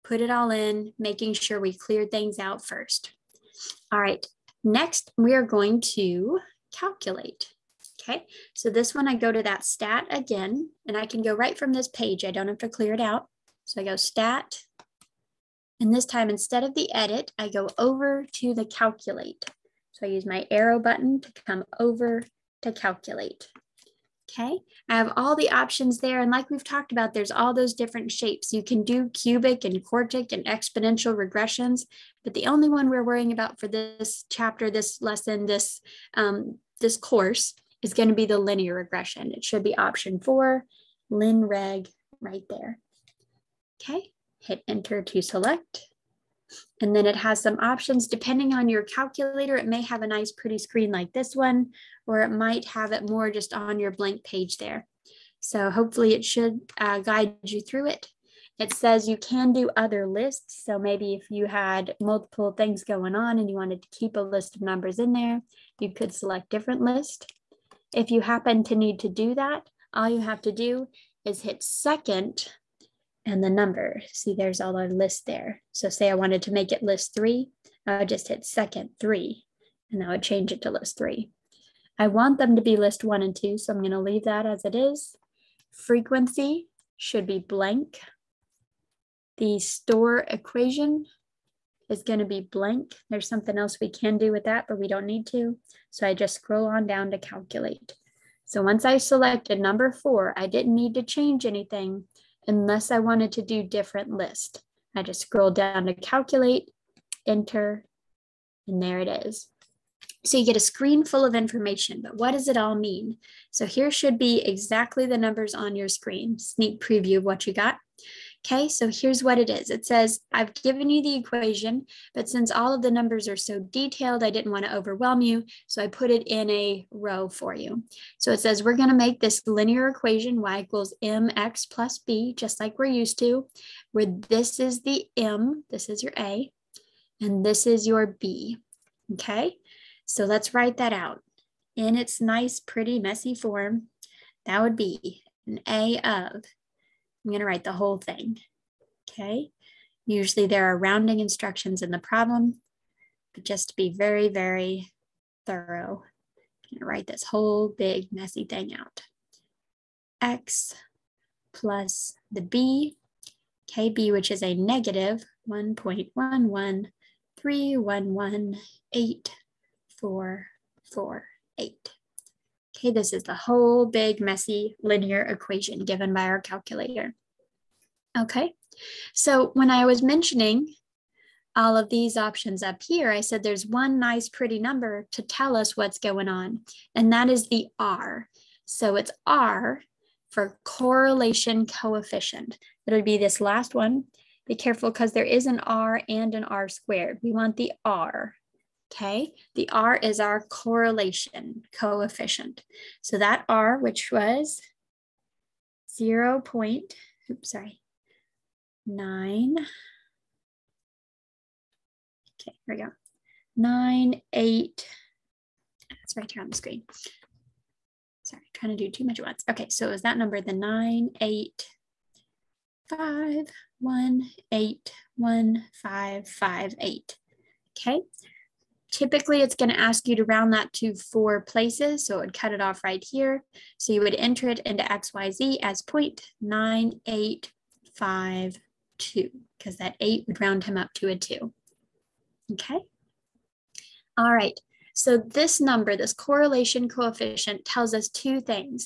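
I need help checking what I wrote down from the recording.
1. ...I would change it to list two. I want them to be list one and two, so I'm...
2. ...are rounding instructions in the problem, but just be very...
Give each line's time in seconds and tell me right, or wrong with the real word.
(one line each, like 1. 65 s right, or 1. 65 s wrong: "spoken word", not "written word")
1. 80 s wrong: "three", not "two"
2. 150 s right.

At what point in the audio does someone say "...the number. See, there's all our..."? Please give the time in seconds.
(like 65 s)
73 s.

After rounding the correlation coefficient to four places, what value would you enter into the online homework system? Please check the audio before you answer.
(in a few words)
0.9852.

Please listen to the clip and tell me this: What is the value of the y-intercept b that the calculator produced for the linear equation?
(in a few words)
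-1.113118448.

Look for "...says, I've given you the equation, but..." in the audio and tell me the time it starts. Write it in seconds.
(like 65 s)
119 s.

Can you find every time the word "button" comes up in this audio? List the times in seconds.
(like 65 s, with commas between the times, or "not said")
20 s.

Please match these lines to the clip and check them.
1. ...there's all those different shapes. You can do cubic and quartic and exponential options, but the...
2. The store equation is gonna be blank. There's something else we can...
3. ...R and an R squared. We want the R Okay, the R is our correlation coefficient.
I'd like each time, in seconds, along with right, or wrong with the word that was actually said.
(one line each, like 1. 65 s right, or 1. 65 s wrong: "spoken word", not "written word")
1. 27 s wrong: "regressions", not "options"
2. 89 s right
3. 195 s right.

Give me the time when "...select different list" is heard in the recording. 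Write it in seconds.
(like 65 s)
66 s.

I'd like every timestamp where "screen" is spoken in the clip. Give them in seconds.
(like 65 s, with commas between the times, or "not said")
50 s, 110 s, 115 s, 216 s.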